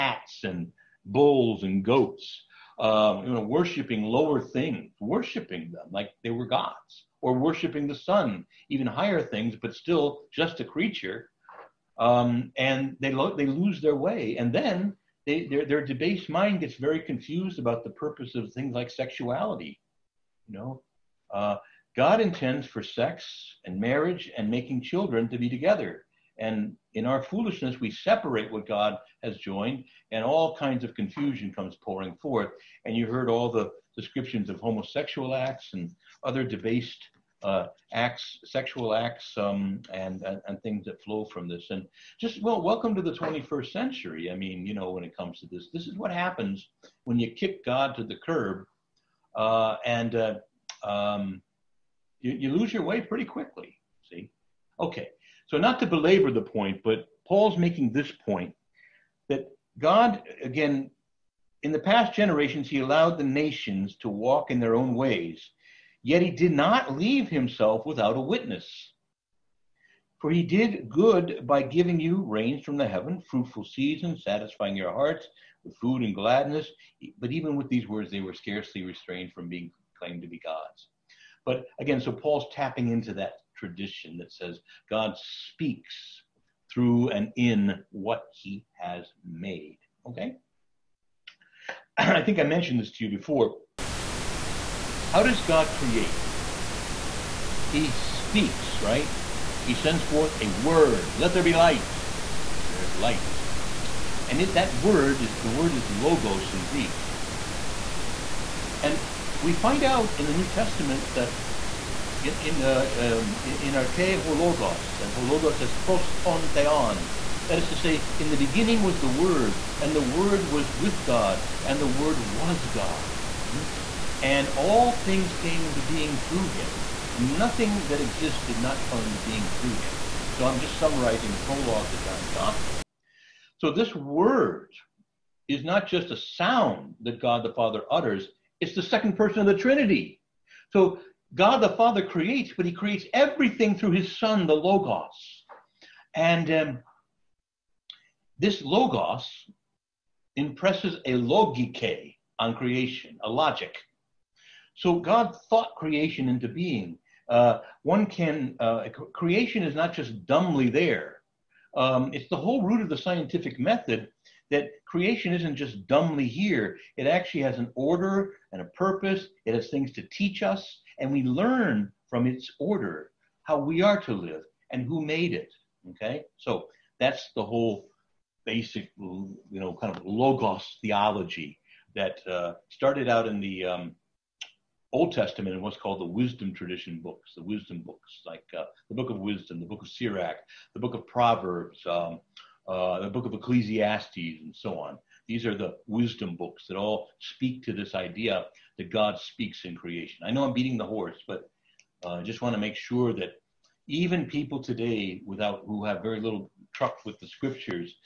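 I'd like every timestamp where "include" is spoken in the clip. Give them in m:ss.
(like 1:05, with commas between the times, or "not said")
not said.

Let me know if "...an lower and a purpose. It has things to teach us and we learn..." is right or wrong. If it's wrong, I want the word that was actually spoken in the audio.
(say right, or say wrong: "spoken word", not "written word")
wrong: "order", not "lower".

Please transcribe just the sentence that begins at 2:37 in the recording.
Uh, one can, uh, creation is not just dumbly there.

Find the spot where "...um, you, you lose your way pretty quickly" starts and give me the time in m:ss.
0:50.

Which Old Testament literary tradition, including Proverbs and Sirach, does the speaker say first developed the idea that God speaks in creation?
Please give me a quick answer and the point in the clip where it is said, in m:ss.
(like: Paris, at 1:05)
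wisdom tradition, at 3:06.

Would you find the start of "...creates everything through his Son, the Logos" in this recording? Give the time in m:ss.
2:22.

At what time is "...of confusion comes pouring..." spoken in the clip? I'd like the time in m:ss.
0:30.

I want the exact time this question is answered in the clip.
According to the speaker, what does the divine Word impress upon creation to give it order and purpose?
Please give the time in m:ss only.
2:33.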